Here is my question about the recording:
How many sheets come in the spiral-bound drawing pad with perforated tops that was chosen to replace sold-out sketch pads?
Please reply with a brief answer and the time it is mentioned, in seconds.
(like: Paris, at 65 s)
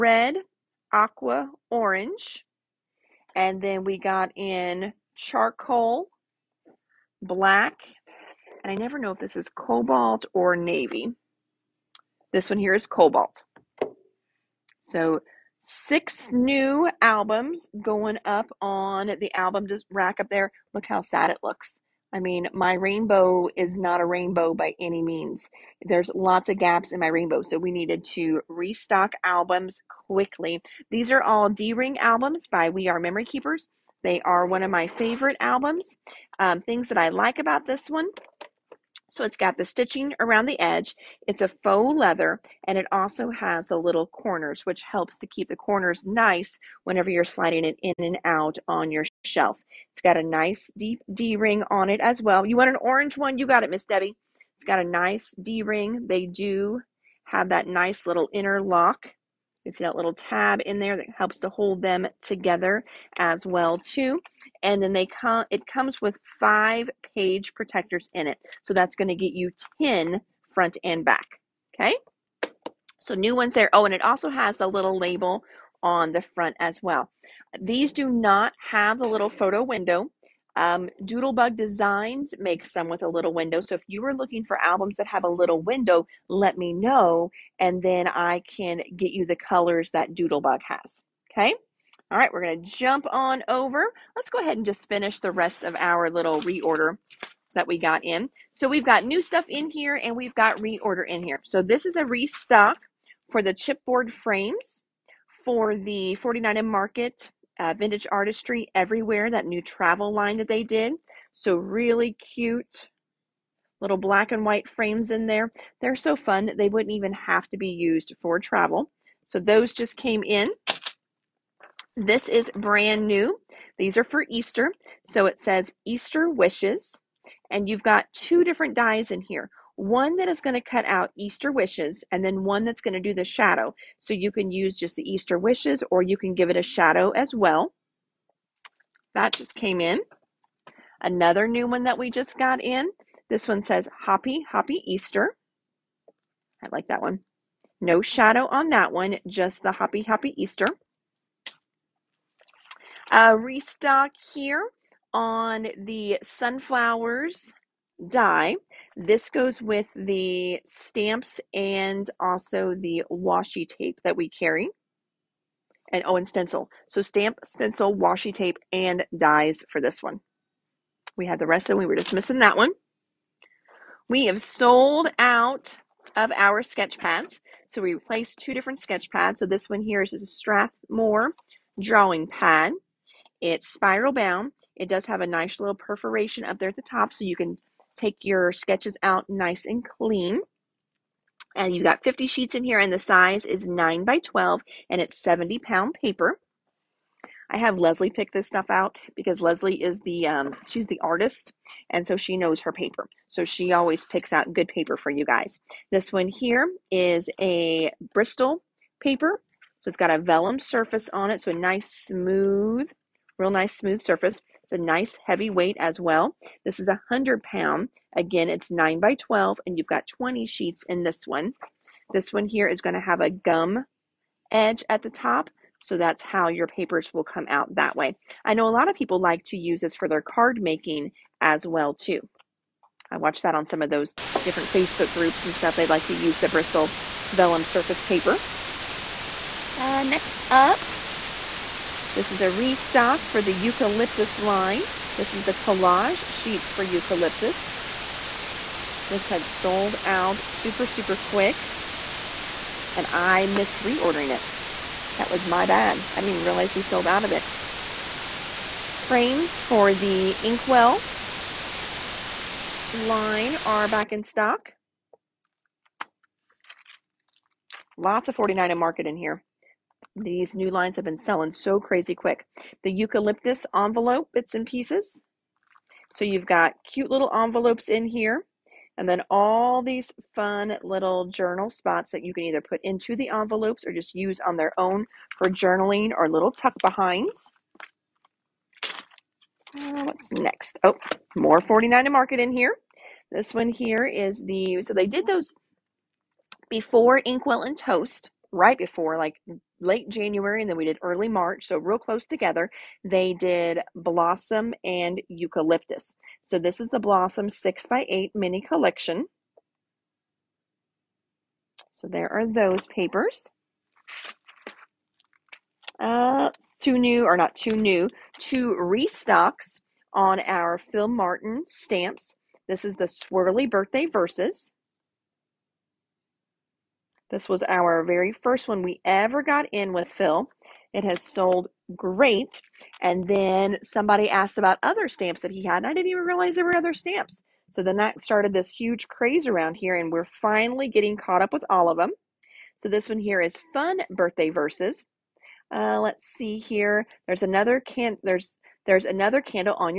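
50, at 192 s.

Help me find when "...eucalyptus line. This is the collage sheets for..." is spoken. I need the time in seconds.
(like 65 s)
243 s.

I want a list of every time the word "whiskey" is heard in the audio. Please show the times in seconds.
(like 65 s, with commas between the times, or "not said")
not said.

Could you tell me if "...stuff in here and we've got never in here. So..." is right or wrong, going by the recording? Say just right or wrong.
wrong.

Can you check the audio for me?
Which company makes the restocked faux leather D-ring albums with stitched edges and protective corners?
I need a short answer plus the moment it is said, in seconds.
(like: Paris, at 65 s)
We Are Memory Keepers, at 32 s.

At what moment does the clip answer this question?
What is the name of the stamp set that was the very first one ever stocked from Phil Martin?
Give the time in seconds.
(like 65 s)
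323 s.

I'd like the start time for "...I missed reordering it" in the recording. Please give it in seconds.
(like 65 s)
253 s.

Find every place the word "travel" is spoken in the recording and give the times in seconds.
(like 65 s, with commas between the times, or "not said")
109 s, 118 s.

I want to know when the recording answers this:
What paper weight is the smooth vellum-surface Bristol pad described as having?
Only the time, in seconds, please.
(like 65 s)
217 s.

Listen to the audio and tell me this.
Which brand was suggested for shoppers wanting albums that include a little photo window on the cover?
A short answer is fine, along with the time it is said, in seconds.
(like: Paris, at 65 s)
Doodlebug Designs, at 81 s.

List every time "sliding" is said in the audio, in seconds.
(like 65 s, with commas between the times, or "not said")
47 s.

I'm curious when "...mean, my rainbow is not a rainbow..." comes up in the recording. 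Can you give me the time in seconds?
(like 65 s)
22 s.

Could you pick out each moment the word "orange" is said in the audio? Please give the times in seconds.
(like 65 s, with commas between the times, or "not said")
1 s, 52 s.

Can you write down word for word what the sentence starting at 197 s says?
I have Leslie pick this stuff out because Leslie is the um, she's the artist, and so she knows her paper.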